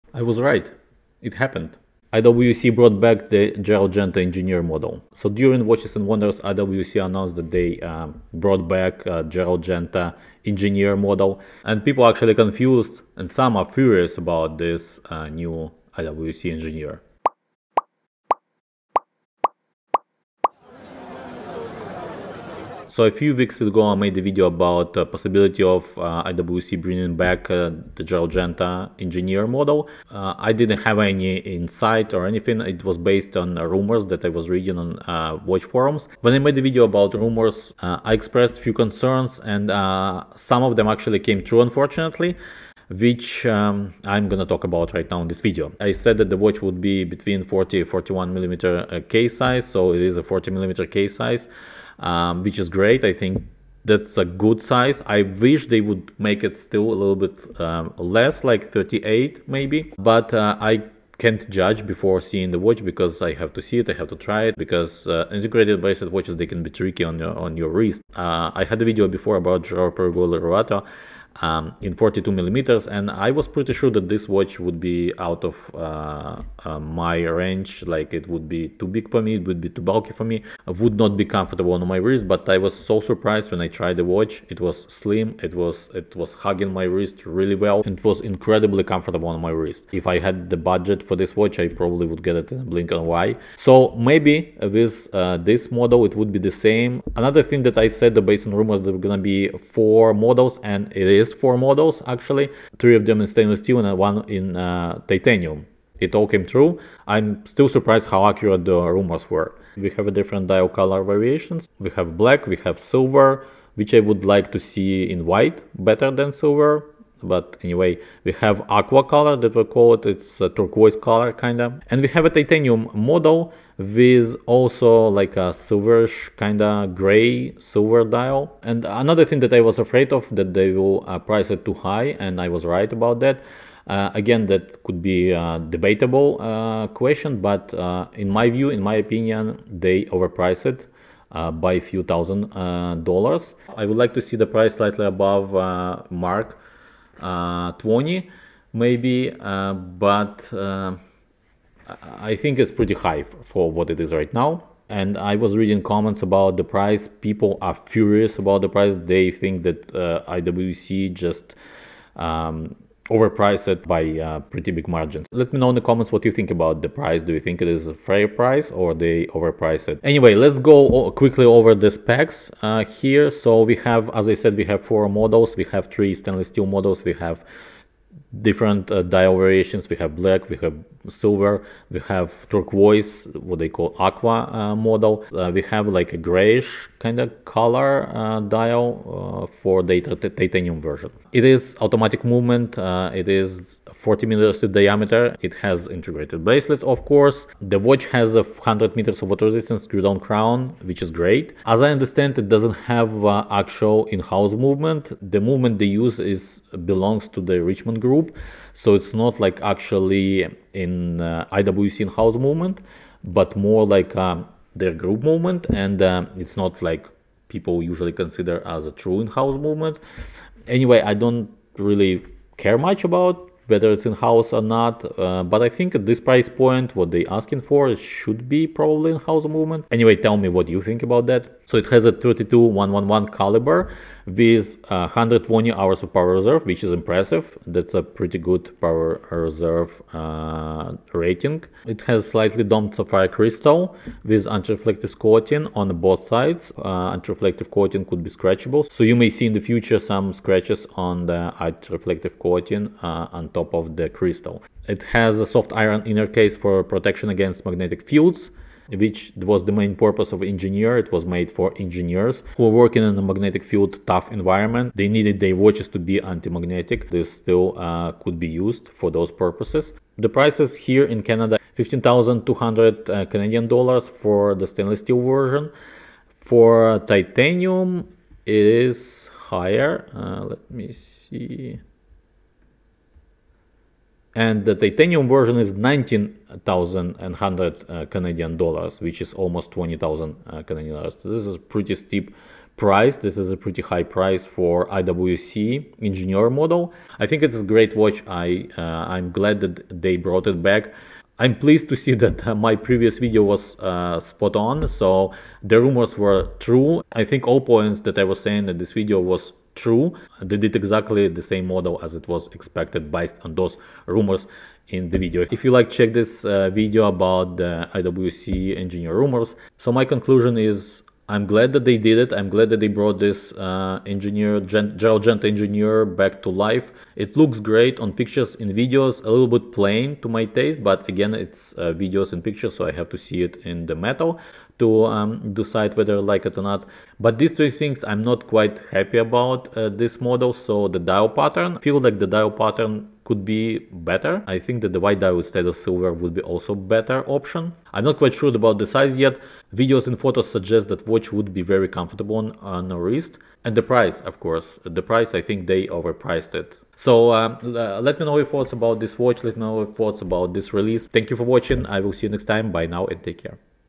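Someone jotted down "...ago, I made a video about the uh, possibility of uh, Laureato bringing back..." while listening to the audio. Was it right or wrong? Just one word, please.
wrong.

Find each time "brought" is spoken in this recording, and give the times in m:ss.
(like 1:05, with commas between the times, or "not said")
0:02, 0:08, 5:00, 5:22.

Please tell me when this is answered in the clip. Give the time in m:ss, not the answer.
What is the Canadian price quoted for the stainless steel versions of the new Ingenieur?
4:31.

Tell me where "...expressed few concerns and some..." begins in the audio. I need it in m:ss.
0:38.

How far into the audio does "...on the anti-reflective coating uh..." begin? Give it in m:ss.
4:10.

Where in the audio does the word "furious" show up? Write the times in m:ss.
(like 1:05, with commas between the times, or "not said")
0:13, 2:37.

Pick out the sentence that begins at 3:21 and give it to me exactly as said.
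As I understand, it doesn't have actual in-house movement.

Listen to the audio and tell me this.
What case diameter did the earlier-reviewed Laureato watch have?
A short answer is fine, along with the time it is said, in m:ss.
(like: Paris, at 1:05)
42 millimeters, at 1:11.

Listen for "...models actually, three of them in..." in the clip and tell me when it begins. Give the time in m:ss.
1:41.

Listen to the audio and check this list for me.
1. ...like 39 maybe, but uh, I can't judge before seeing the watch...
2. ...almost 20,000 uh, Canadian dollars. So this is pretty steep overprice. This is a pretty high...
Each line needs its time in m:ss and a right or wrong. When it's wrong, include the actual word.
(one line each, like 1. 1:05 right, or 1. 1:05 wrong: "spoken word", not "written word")
1. 0:58 wrong: "38", not "39"
2. 4:49 wrong: "price", not "overprice".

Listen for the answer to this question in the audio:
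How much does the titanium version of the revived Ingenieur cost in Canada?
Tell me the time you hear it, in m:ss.
4:45.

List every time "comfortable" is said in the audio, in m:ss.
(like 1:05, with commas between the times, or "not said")
1:21, 1:28, 5:51.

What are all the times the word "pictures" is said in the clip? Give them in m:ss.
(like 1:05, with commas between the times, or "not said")
5:28, 5:32.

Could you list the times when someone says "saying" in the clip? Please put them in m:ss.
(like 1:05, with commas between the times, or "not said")
5:08.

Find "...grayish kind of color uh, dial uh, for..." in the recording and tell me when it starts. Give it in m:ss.
3:06.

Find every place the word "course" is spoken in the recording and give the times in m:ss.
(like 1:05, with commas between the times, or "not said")
3:17, 5:54.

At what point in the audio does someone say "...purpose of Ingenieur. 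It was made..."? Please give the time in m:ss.
4:20.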